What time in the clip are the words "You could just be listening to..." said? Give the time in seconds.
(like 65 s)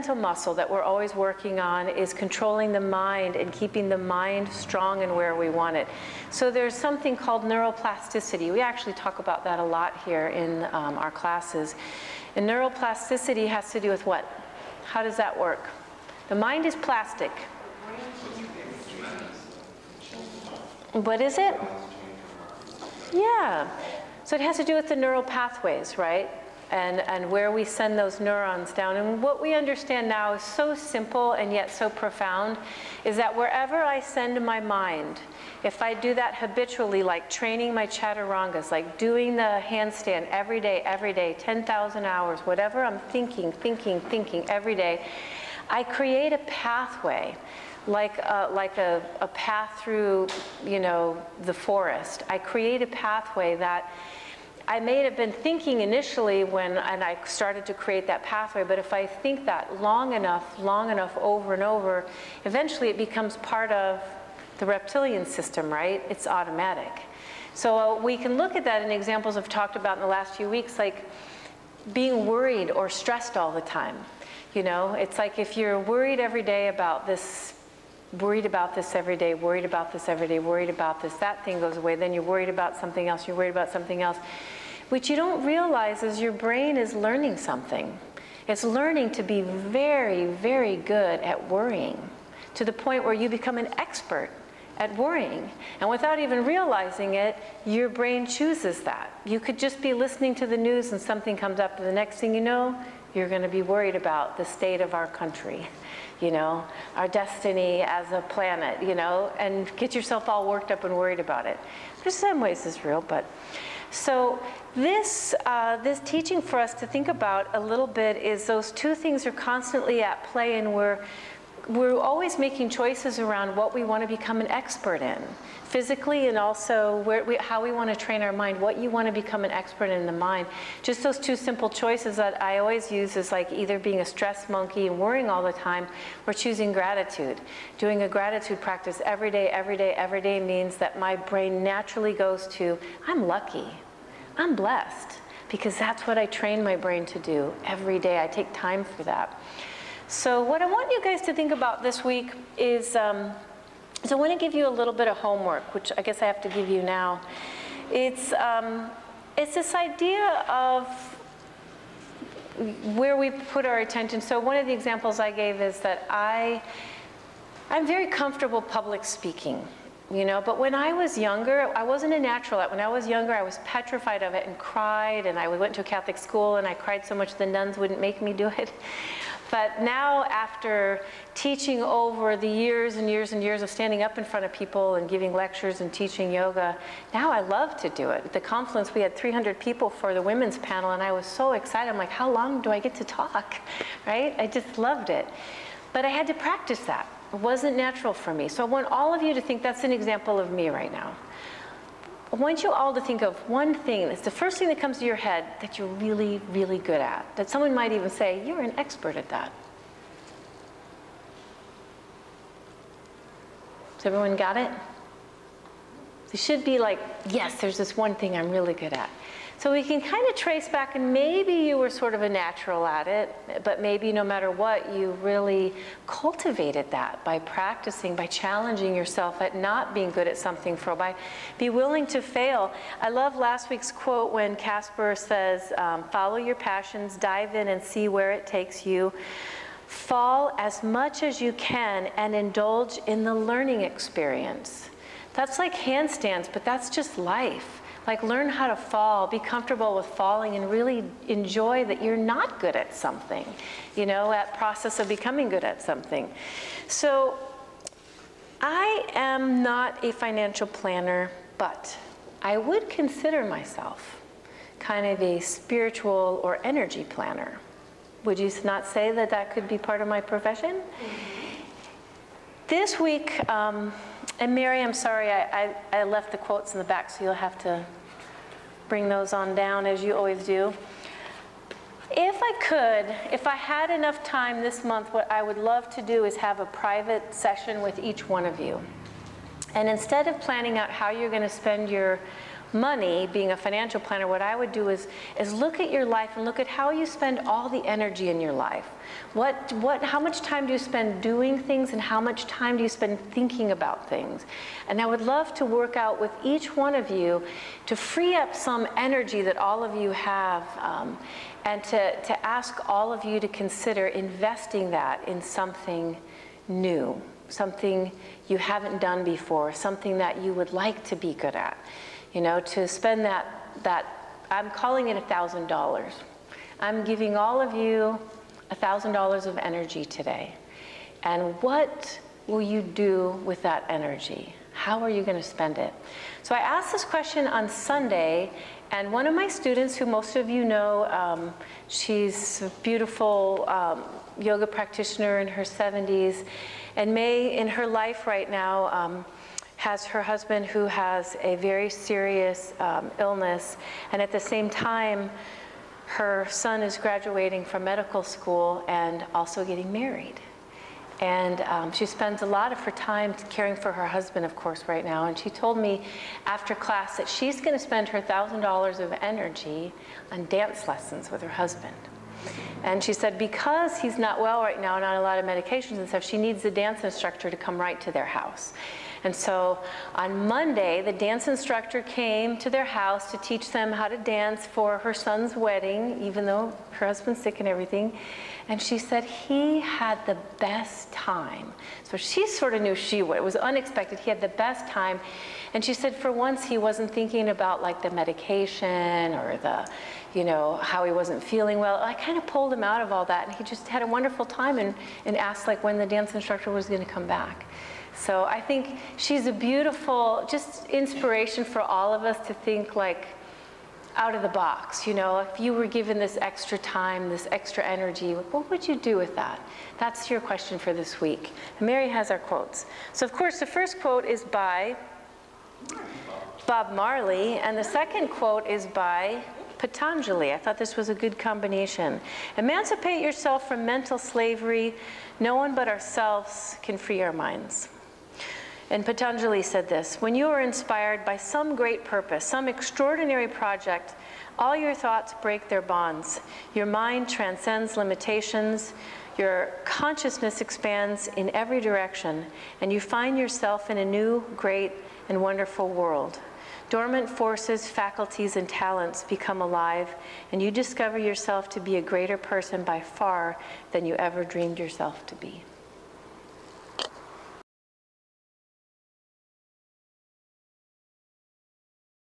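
99 s.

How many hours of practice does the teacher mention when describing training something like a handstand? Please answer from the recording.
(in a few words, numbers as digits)
10,000 hours.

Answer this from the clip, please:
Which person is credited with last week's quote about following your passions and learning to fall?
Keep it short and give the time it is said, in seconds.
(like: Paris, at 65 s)
Casper, at 234 s.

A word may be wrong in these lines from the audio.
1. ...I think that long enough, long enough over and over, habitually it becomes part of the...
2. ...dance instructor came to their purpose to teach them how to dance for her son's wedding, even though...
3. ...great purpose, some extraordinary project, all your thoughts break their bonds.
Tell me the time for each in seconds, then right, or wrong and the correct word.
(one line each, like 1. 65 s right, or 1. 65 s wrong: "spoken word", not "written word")
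1. 58 s wrong: "eventually", not "habitually"
2. 381 s wrong: "house", not "purpose"
3. 441 s right.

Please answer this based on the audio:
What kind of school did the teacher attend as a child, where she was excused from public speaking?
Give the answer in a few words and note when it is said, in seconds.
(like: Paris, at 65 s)
Catholic school, at 175 s.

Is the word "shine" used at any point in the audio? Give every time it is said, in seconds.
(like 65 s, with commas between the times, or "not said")
not said.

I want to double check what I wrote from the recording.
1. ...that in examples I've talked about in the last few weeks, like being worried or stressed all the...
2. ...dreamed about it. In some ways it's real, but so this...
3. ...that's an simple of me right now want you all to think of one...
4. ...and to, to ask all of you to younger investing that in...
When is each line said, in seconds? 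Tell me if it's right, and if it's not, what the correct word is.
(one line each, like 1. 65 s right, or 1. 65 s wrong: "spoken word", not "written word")
1. 68 s right
2. 110 s wrong: "worried", not "dreamed"
3. 199 s wrong: "example", not "simple"
4. 311 s wrong: "consider", not "younger".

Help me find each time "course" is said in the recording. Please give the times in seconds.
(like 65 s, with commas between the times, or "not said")
364 s, 423 s.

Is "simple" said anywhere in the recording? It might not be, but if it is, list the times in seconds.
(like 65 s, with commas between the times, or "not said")
30 s, 131 s.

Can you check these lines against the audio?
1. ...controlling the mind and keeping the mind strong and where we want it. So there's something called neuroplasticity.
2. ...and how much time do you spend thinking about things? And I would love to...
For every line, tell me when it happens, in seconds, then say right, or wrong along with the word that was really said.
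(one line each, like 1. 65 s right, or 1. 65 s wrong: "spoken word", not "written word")
1. 2 s right
2. 301 s right.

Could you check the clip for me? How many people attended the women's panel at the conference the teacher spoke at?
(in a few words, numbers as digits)
300.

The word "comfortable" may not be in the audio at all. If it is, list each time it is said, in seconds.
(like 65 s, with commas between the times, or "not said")
168 s, 249 s.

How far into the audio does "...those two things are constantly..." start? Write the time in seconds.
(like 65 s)
118 s.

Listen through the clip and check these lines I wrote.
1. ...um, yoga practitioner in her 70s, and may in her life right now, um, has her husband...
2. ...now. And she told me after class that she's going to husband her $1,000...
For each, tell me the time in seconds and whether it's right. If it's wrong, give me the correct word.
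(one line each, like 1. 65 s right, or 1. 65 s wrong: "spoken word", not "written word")
1. 343 s right
2. 365 s wrong: "spend", not "husband".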